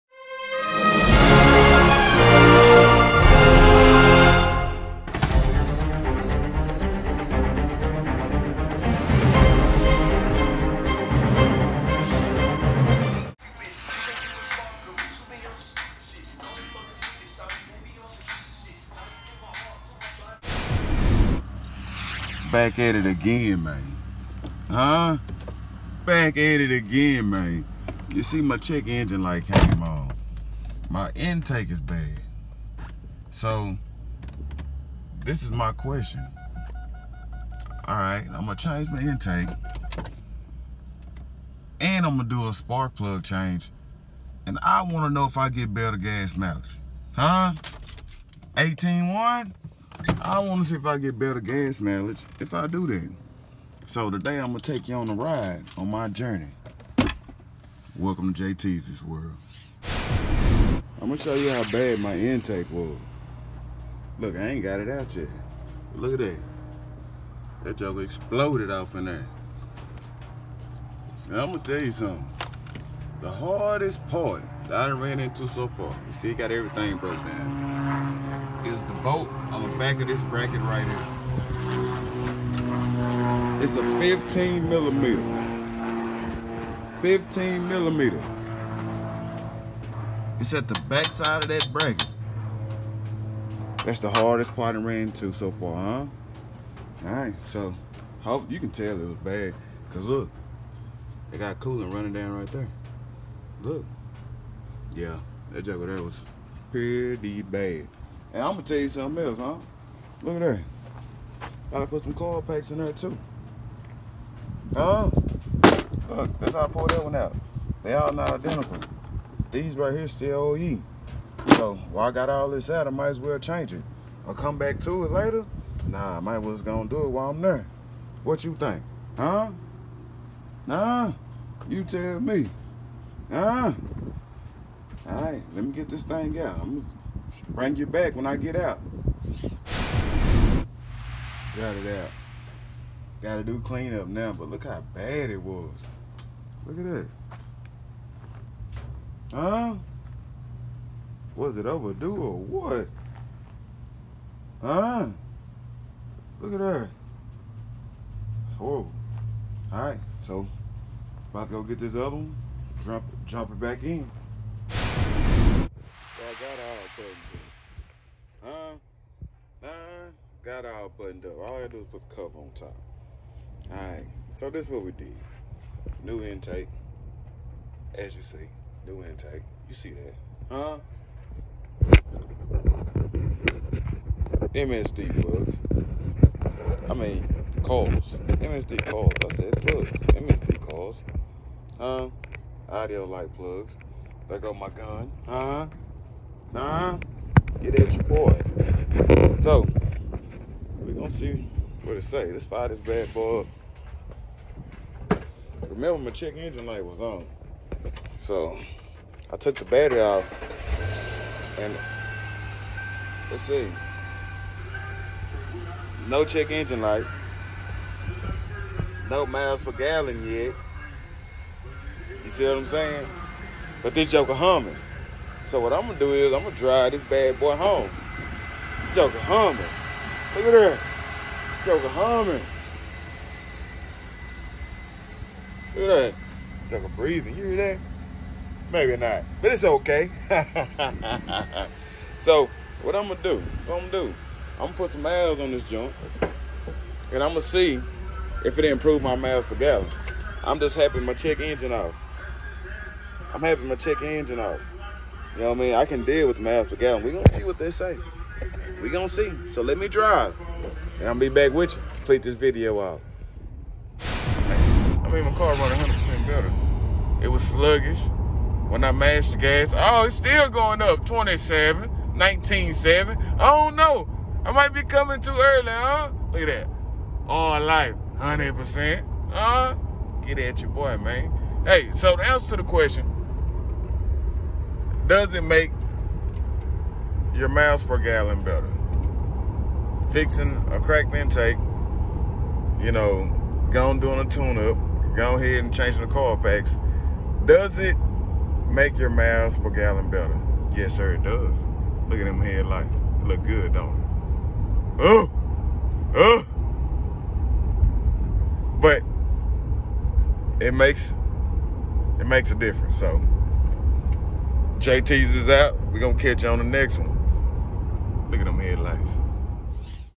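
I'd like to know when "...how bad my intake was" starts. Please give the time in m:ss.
1:01.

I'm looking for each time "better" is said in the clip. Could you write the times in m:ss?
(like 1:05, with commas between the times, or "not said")
0:45, 0:51, 4:26, 4:48, 5:00.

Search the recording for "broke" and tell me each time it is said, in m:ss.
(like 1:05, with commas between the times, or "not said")
1:16.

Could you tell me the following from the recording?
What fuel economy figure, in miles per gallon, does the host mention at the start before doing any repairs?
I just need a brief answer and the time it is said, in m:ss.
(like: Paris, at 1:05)
18.1, at 0:48.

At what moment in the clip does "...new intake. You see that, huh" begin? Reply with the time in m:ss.
2:58.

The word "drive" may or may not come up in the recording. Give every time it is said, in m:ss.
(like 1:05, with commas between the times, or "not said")
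3:46, 4:19.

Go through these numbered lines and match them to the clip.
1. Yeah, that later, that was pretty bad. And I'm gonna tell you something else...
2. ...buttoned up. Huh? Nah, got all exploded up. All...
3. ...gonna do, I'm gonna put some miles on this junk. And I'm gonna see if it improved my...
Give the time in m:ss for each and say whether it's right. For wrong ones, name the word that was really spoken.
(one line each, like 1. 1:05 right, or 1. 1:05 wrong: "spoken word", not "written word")
1. 1:44 wrong: "joker", not "later"
2. 2:46 wrong: "buttoned", not "exploded"
3. 4:03 right.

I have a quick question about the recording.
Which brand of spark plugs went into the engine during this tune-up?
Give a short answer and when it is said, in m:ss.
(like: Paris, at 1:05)
Autolite, at 3:12.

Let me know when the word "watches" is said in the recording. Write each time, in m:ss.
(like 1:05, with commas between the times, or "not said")
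not said.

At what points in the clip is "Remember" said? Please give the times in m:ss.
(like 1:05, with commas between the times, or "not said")
3:25.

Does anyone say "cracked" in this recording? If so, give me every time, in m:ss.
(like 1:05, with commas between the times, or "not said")
4:50.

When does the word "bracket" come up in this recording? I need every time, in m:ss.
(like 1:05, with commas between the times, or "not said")
1:20, 1:31.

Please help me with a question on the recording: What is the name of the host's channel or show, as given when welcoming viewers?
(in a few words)
JT's World.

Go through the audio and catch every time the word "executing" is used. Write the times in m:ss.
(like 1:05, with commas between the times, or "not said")
not said.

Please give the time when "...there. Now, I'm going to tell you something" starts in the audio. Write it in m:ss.
1:09.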